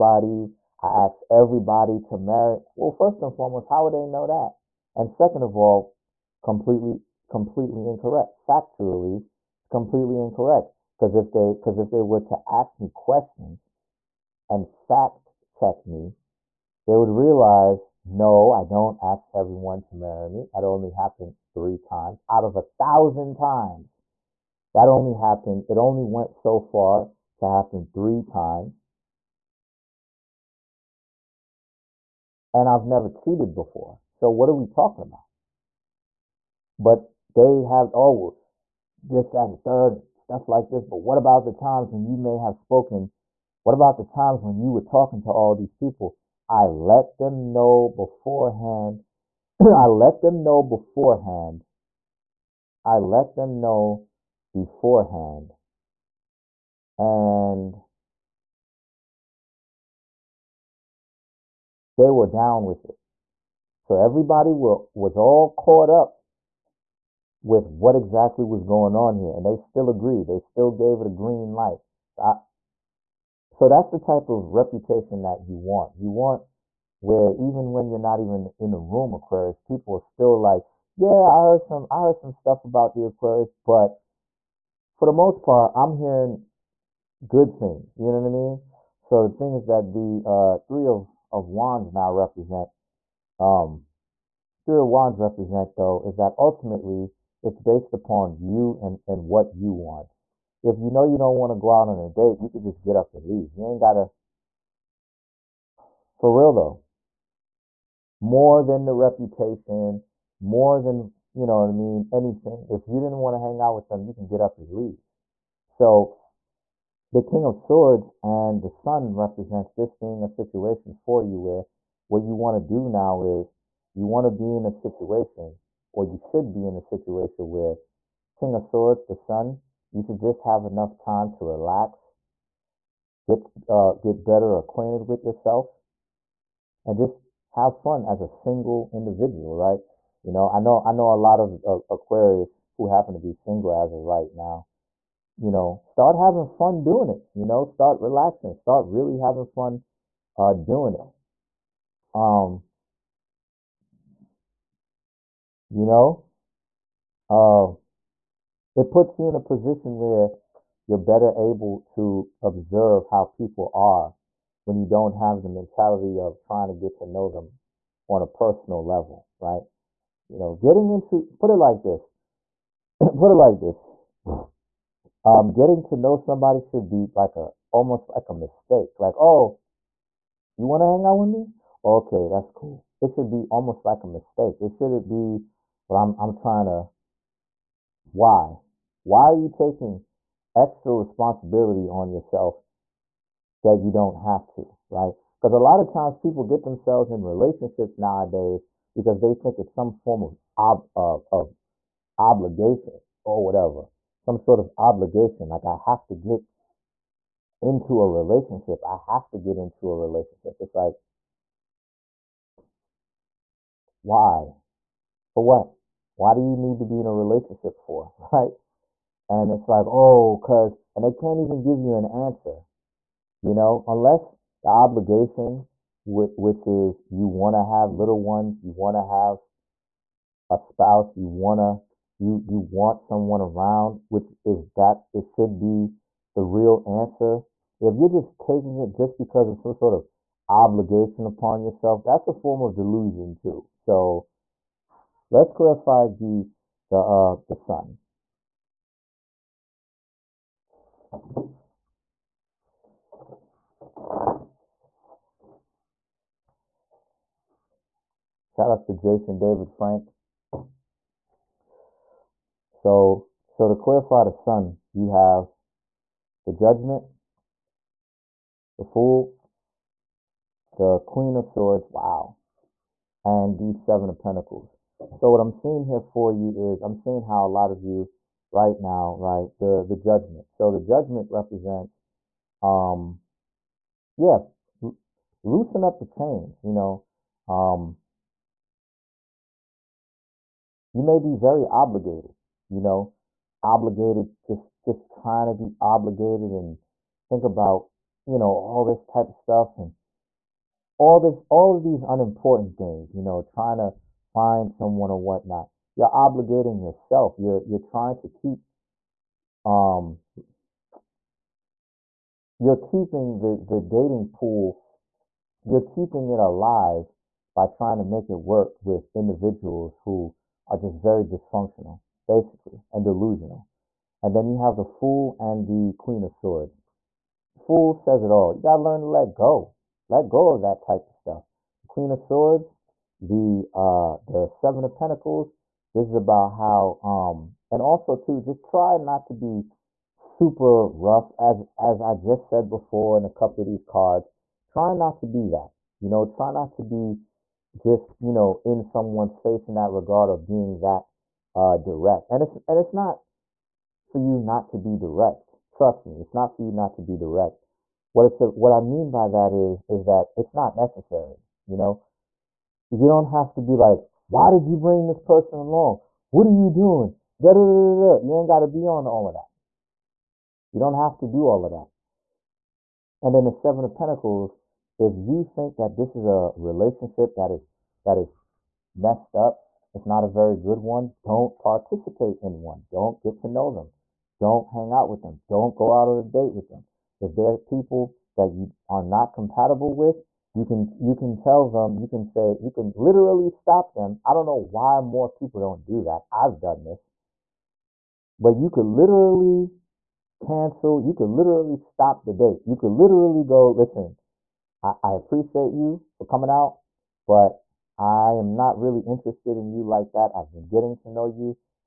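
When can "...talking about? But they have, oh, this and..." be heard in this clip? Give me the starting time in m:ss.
0:34.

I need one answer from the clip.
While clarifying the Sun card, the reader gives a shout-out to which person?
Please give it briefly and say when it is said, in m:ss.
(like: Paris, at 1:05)
Jason David Frank, at 4:18.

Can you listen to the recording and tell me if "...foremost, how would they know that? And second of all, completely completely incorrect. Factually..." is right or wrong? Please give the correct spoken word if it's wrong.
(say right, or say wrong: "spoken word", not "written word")
right.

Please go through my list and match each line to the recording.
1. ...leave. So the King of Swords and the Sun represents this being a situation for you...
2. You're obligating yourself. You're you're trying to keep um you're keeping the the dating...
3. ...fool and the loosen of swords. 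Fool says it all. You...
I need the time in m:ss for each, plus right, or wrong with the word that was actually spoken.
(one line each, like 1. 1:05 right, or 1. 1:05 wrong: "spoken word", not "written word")
1. 1:54 right
2. 5:05 right
3. 5:24 wrong: "queen", not "loosen".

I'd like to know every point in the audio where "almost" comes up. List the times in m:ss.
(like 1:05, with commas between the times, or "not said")
2:57, 3:03.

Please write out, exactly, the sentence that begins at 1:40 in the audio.
If you know you don't want to go out on a date, you could just get up and leave.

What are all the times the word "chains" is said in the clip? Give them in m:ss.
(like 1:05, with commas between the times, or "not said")
4:46.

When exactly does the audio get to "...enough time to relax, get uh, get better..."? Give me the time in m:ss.
2:10.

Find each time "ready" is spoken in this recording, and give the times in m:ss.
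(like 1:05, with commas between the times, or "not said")
not said.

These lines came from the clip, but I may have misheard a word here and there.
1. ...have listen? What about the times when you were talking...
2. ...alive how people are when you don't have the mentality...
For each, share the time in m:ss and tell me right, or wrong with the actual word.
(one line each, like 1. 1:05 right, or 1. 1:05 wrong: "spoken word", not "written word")
1. 0:42 wrong: "spoken", not "listen"
2. 2:42 wrong: "observe", not "alive".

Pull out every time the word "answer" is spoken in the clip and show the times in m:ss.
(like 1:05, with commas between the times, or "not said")
3:42, 3:56.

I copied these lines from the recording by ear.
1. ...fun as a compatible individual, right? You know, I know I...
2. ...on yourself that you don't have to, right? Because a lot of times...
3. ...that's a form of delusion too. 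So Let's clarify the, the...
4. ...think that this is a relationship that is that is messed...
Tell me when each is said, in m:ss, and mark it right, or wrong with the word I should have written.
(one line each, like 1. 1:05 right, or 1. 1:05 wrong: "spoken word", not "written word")
1. 2:17 wrong: "single", not "compatible"
2. 3:11 right
3. 4:02 right
4. 6:15 right.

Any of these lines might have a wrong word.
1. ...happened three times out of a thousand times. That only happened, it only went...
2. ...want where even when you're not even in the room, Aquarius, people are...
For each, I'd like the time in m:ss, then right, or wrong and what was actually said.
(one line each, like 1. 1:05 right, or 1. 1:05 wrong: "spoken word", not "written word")
1. 0:20 right
2. 1:16 right.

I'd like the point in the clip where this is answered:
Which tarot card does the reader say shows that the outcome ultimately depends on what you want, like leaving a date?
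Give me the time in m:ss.
1:34.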